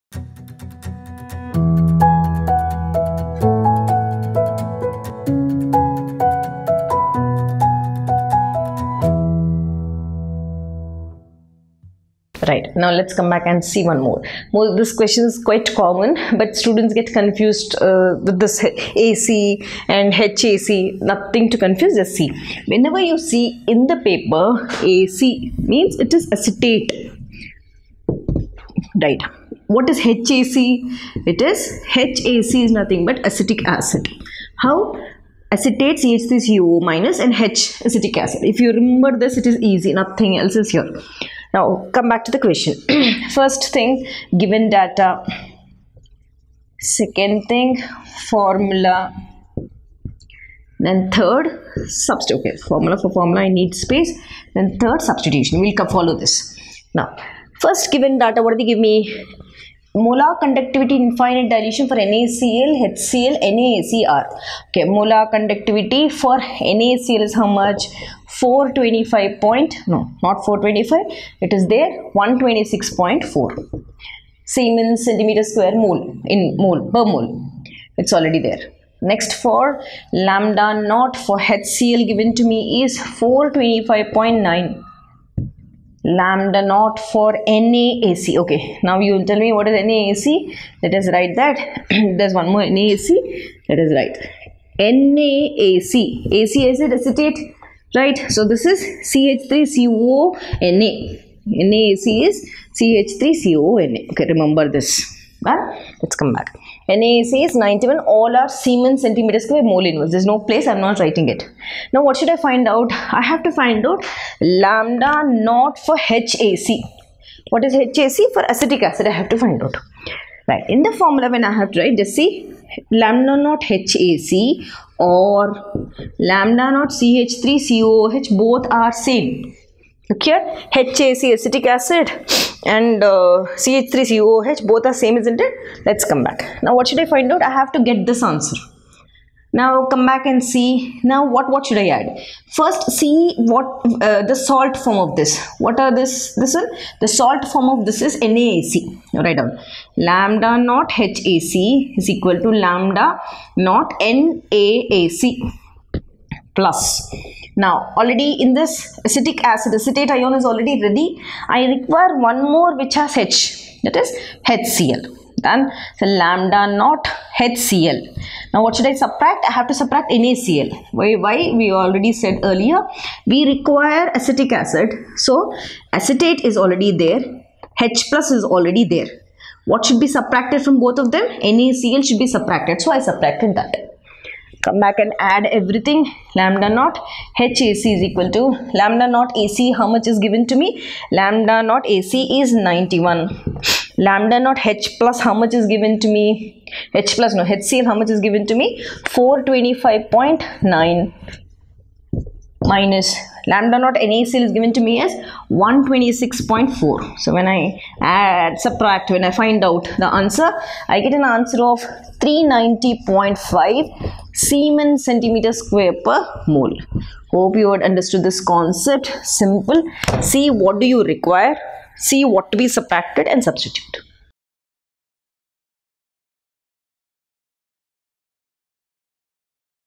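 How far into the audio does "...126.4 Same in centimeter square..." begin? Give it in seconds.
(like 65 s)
72 s.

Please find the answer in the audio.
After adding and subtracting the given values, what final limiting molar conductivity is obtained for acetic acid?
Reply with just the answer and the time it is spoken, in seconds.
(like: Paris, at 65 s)
390.5, at 212 s.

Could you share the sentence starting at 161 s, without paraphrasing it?
I require one more which has H that is HCl.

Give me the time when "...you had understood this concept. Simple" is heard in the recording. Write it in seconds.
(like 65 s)
217 s.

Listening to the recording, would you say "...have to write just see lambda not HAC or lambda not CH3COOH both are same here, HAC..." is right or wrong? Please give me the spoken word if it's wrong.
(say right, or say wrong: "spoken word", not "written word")
right.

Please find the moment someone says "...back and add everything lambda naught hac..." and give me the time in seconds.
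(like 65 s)
184 s.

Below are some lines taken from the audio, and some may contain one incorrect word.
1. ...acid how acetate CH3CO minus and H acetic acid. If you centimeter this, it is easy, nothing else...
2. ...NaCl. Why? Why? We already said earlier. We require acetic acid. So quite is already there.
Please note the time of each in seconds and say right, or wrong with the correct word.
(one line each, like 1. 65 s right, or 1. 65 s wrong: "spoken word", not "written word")
1. 33 s wrong: "remember", not "centimeter"
2. 170 s wrong: "acetate", not "quite".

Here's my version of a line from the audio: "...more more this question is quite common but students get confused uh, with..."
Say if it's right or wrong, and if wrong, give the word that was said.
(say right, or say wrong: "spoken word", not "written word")
right.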